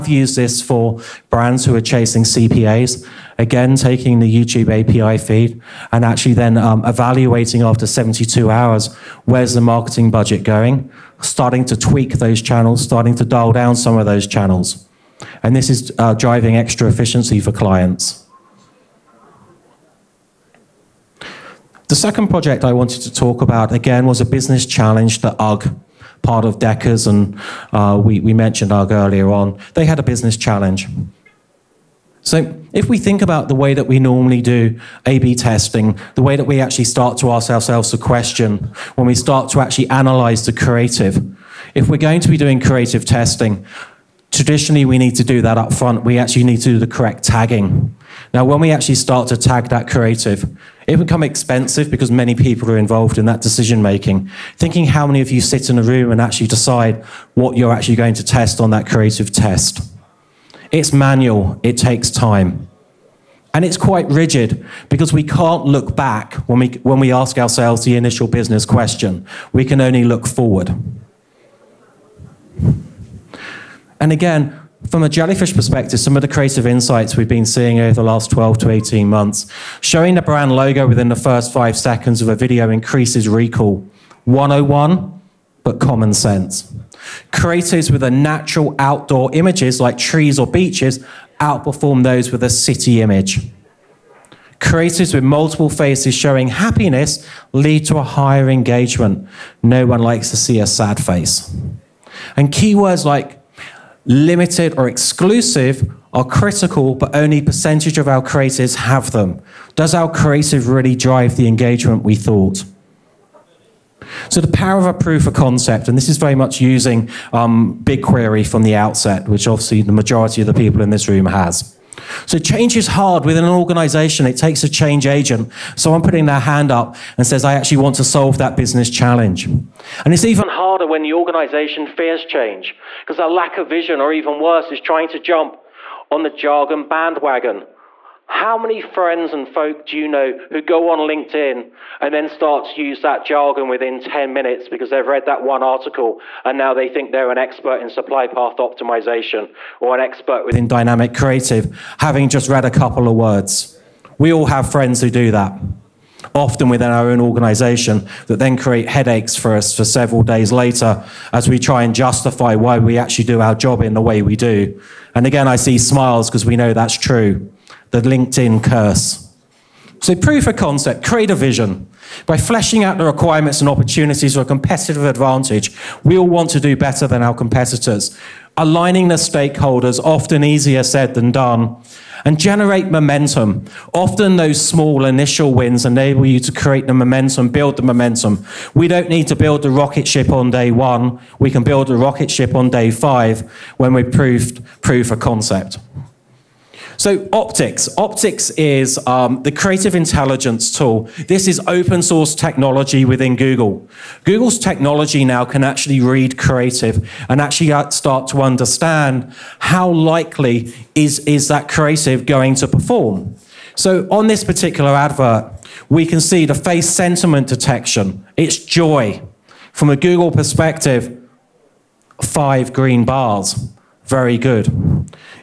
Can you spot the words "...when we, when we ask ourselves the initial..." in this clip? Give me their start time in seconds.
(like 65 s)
66 s.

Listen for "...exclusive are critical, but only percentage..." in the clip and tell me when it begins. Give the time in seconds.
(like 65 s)
104 s.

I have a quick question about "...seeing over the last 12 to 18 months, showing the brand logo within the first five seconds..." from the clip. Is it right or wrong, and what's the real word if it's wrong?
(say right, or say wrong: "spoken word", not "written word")
right.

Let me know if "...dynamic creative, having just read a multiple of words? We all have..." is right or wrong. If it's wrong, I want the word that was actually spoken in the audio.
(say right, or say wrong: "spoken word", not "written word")
wrong: "couple", not "multiple".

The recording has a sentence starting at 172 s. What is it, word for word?
By fleshing out the requirements and opportunities for a competitive advantage, we all want to do better than our competitors.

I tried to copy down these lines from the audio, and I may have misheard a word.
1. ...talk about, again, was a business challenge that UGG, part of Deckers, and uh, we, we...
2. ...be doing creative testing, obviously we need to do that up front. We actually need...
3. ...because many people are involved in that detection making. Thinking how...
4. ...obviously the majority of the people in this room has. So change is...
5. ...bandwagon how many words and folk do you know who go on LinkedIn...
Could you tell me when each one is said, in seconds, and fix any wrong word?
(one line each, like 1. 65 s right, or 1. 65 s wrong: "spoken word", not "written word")
1. 23 s right
2. 42 s wrong: "traditionally", not "obviously"
3. 51 s wrong: "decision", not "detection"
4. 119 s right
5. 136 s wrong: "friends", not "words".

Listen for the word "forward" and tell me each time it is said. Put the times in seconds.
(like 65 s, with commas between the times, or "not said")
70 s.